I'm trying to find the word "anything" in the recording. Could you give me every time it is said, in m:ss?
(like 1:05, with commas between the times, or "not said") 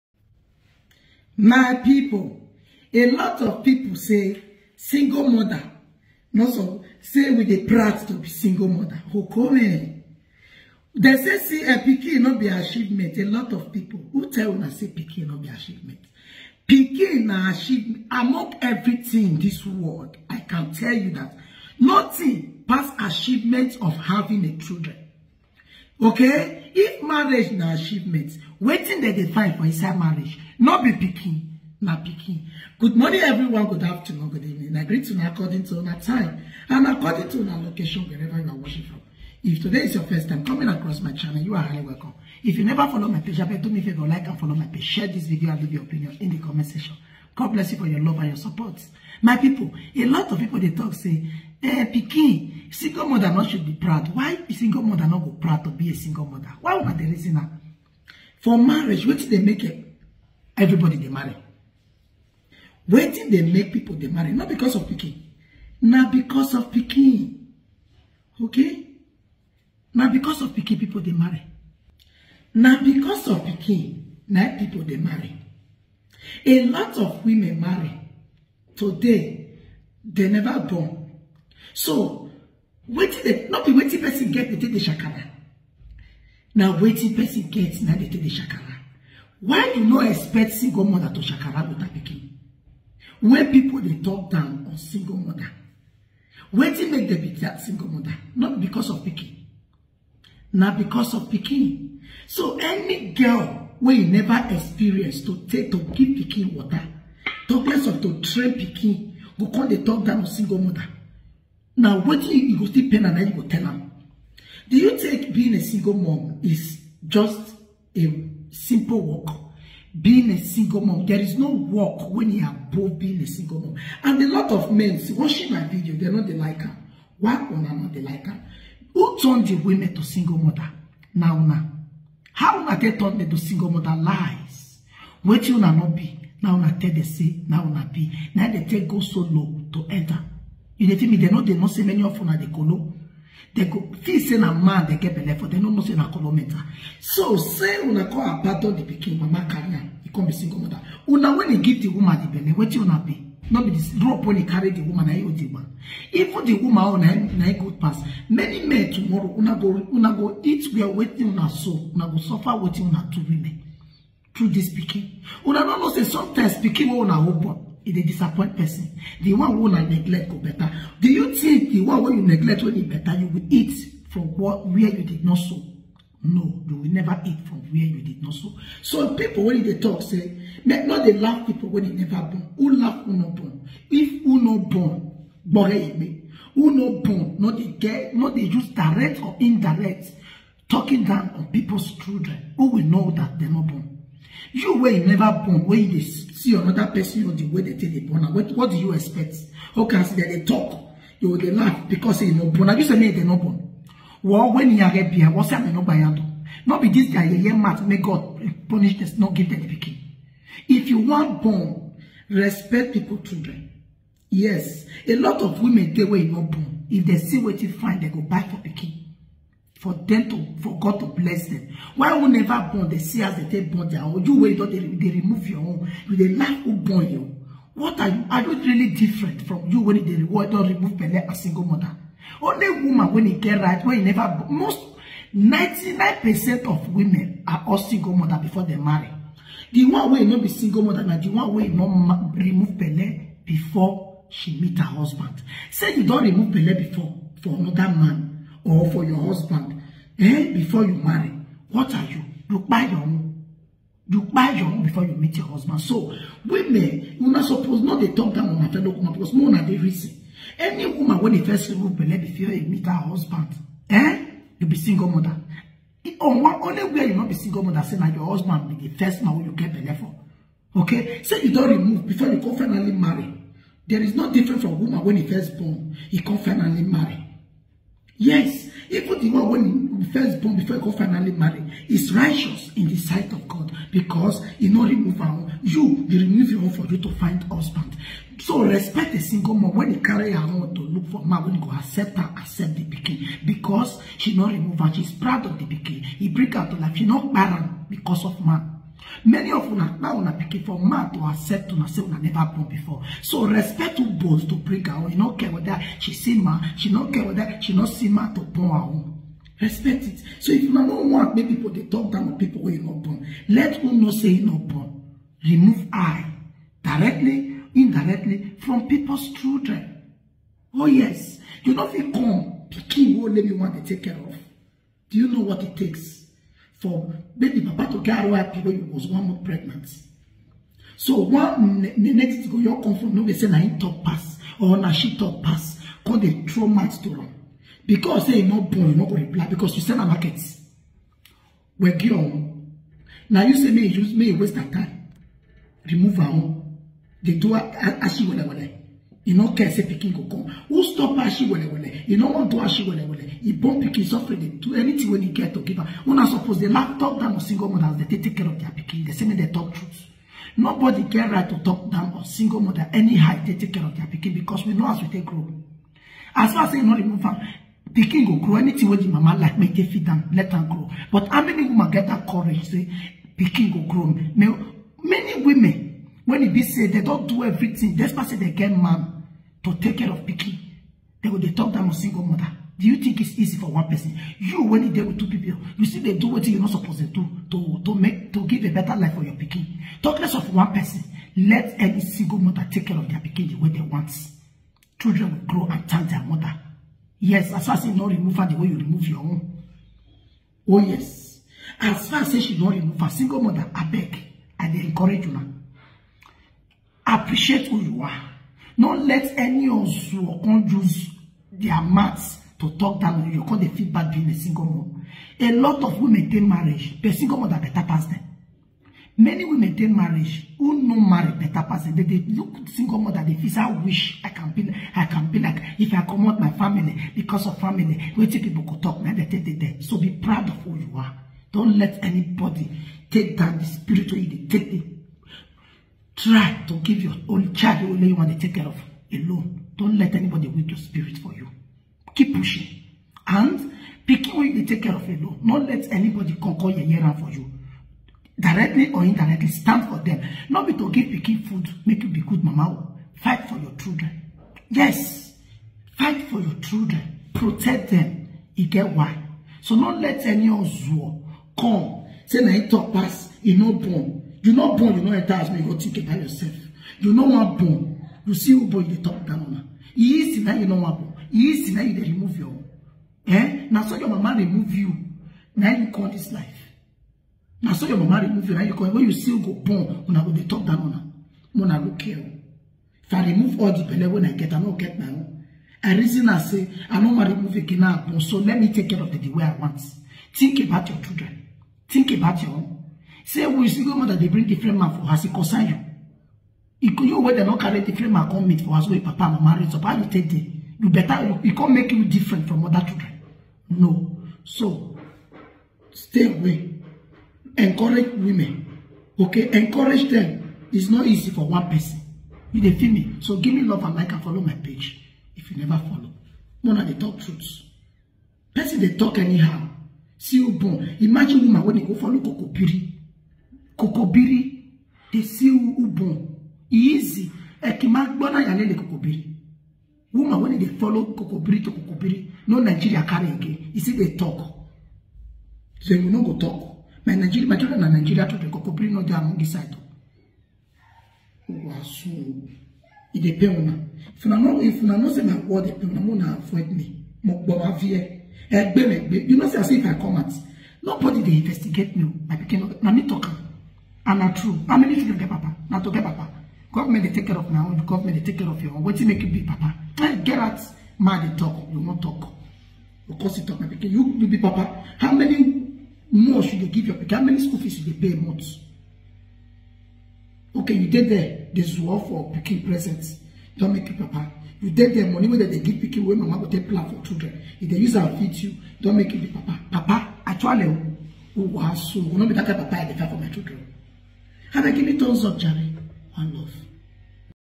5:54, 6:08.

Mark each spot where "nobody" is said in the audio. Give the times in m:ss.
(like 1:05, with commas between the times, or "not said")
6:00, 9:10.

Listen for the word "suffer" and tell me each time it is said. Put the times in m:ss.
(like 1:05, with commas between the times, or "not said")
2:42, 5:54.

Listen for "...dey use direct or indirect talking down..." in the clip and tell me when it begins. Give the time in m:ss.
3:08.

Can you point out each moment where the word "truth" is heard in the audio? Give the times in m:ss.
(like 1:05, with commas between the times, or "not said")
5:59, 8:37.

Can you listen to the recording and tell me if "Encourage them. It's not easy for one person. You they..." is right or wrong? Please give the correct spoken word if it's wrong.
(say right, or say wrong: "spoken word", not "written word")
right.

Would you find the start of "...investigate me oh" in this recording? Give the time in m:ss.
9:11.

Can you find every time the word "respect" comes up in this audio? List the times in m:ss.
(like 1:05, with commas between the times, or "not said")
3:32, 4:48, 5:03, 5:09.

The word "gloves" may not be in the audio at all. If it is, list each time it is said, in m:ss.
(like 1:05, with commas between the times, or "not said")
not said.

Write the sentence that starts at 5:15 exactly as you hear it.
Remove I directly, indirectly from people's children.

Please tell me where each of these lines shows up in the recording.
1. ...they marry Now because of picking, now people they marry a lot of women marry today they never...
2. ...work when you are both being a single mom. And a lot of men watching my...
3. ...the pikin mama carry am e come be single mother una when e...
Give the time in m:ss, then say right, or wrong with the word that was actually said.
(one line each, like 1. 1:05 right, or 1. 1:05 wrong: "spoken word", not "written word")
1. 1:11 right
2. 2:01 right
3. 2:28 right.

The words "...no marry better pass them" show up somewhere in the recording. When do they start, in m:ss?
7:00.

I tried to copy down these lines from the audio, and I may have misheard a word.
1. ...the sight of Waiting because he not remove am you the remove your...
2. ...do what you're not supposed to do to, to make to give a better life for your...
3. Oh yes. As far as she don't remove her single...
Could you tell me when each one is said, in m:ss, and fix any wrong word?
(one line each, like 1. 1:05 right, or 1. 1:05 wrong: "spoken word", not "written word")
1. 4:42 wrong: "God", not "Waiting"
2. 6:26 right
3. 6:40 right.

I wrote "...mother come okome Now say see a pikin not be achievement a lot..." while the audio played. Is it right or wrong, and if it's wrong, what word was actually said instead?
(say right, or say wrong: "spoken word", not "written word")
wrong: "They", not "Now".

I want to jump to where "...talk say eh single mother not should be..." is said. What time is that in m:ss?
0:50.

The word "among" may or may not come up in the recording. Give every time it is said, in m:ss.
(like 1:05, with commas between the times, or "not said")
0:18, 8:59.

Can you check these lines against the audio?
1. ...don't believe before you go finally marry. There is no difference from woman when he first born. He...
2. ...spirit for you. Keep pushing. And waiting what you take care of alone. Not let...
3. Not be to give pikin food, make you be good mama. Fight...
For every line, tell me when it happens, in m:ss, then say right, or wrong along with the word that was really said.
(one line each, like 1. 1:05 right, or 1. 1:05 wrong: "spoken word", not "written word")
1. 4:31 wrong: "remove", not "believe"
2. 7:20 wrong: "picking", not "waiting"
3. 7:30 right.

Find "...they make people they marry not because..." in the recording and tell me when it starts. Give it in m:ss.
1:03.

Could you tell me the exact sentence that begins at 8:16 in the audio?
If could you where they not carry different man come meet for us, with papa, mama, raise up, how you take it?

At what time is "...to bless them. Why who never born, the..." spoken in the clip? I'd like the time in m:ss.
3:40.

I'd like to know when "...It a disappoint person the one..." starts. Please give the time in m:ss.
2:47.